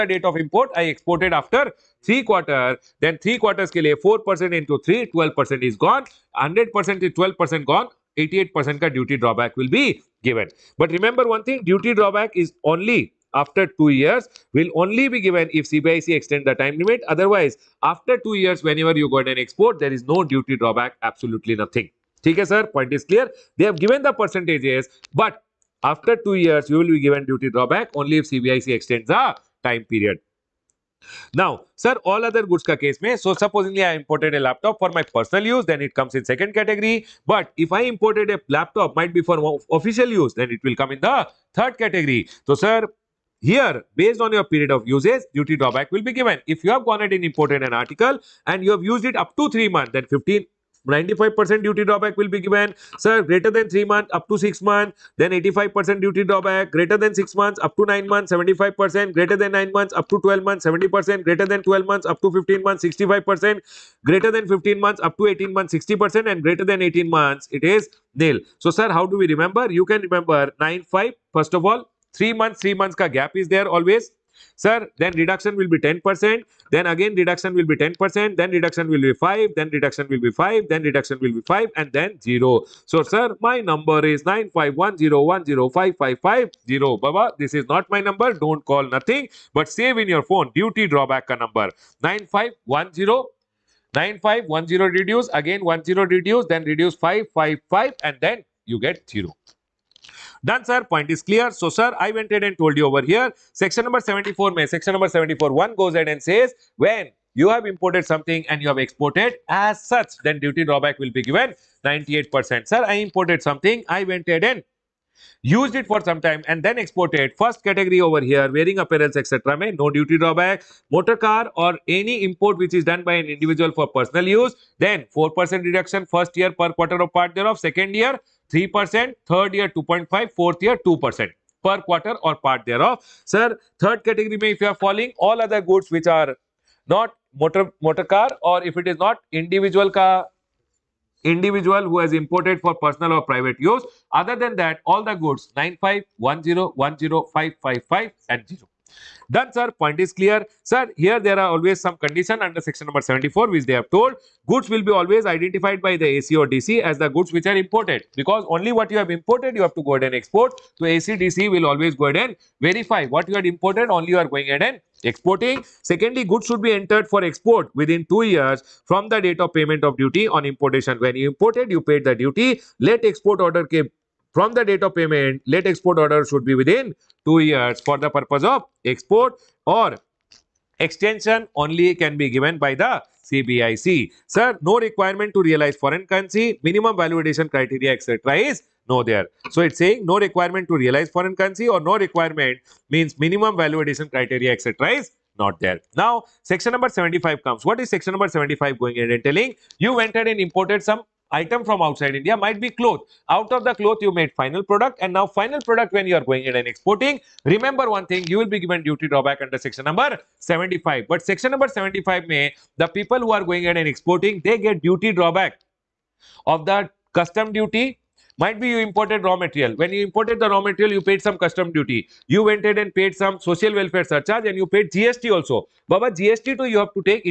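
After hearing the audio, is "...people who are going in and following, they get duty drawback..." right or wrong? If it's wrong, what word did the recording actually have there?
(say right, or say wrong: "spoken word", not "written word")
wrong: "exporting", not "following".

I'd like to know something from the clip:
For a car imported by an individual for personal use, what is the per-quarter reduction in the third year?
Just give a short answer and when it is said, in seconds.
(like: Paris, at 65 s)
2.5%, at 129 s.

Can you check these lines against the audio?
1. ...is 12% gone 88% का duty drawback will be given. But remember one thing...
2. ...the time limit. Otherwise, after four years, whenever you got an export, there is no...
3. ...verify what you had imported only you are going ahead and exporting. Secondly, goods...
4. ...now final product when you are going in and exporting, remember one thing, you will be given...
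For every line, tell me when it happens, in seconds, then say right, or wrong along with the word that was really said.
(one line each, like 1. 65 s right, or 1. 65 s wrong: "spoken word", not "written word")
1. 7 s right
2. 16 s wrong: "two", not "four"
3. 162 s right
4. 205 s right.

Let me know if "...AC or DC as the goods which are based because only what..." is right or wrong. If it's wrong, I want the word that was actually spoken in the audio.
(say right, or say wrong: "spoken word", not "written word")
wrong: "imported", not "based".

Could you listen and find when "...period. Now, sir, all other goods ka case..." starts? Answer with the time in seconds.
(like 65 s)
29 s.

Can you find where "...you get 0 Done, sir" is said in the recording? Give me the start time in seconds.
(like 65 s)
98 s.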